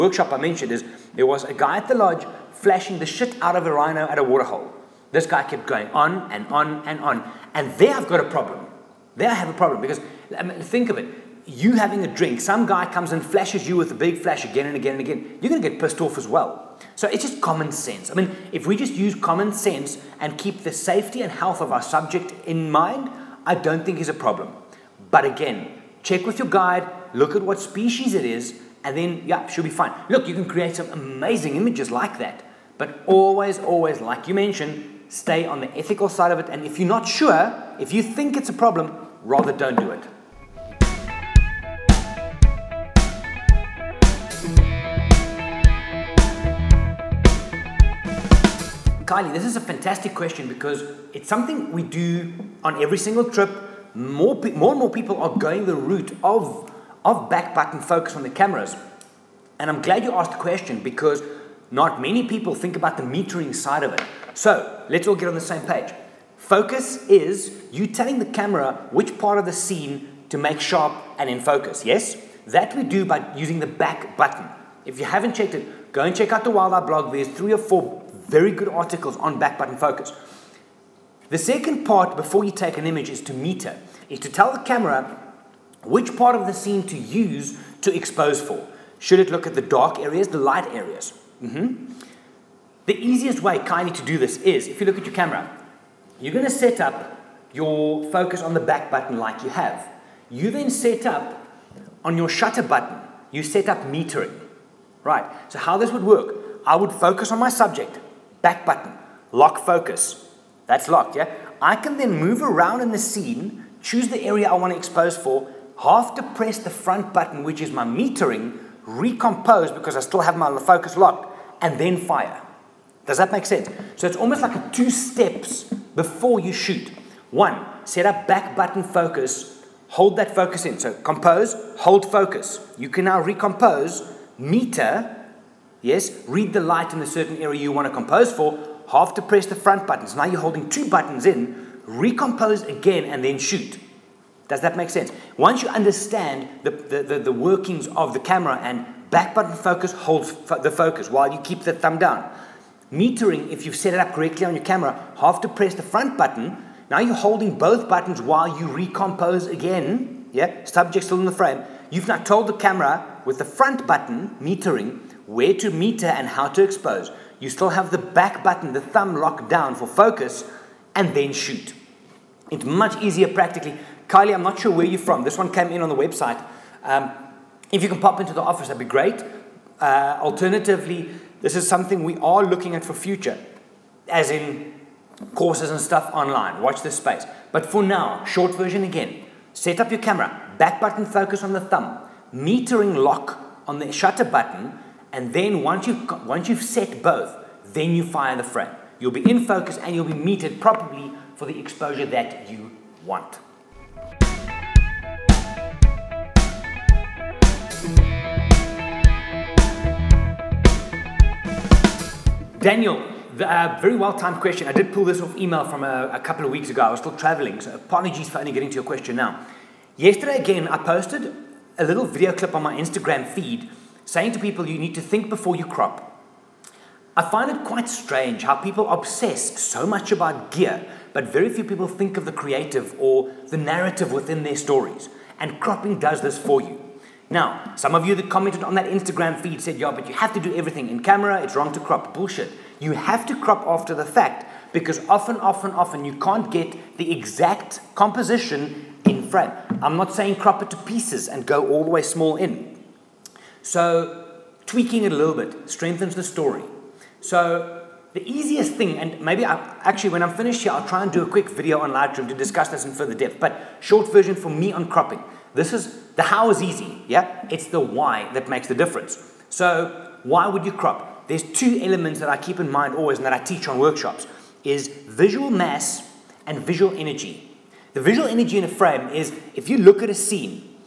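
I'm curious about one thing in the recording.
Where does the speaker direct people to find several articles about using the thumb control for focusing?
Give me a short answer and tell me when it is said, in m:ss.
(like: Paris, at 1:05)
Wild Eye blog, at 1:16.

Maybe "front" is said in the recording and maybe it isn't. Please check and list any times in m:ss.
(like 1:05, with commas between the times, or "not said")
1:56, 2:19, 2:35, 2:43.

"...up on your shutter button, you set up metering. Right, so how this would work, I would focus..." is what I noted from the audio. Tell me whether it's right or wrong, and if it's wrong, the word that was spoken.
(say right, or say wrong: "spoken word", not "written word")
right.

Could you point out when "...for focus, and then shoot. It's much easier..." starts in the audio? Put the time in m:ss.
2:49.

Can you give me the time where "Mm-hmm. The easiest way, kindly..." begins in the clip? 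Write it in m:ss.
1:31.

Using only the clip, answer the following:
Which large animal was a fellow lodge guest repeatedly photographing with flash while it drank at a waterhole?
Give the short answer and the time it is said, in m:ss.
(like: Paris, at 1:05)
rhino, at 0:03.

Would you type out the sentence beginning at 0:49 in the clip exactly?
Riley, this is a fantastic question because it's something we do on every single trip.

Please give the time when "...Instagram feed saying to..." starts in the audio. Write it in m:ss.
3:42.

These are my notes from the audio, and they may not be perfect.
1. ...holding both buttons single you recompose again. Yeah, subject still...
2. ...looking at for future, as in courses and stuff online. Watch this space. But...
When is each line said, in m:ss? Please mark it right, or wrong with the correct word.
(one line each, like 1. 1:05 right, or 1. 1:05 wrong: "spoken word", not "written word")
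1. 2:37 wrong: "while", not "single"
2. 3:02 right.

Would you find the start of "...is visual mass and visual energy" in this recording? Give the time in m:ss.
4:34.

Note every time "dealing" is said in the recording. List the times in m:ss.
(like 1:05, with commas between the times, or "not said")
not said.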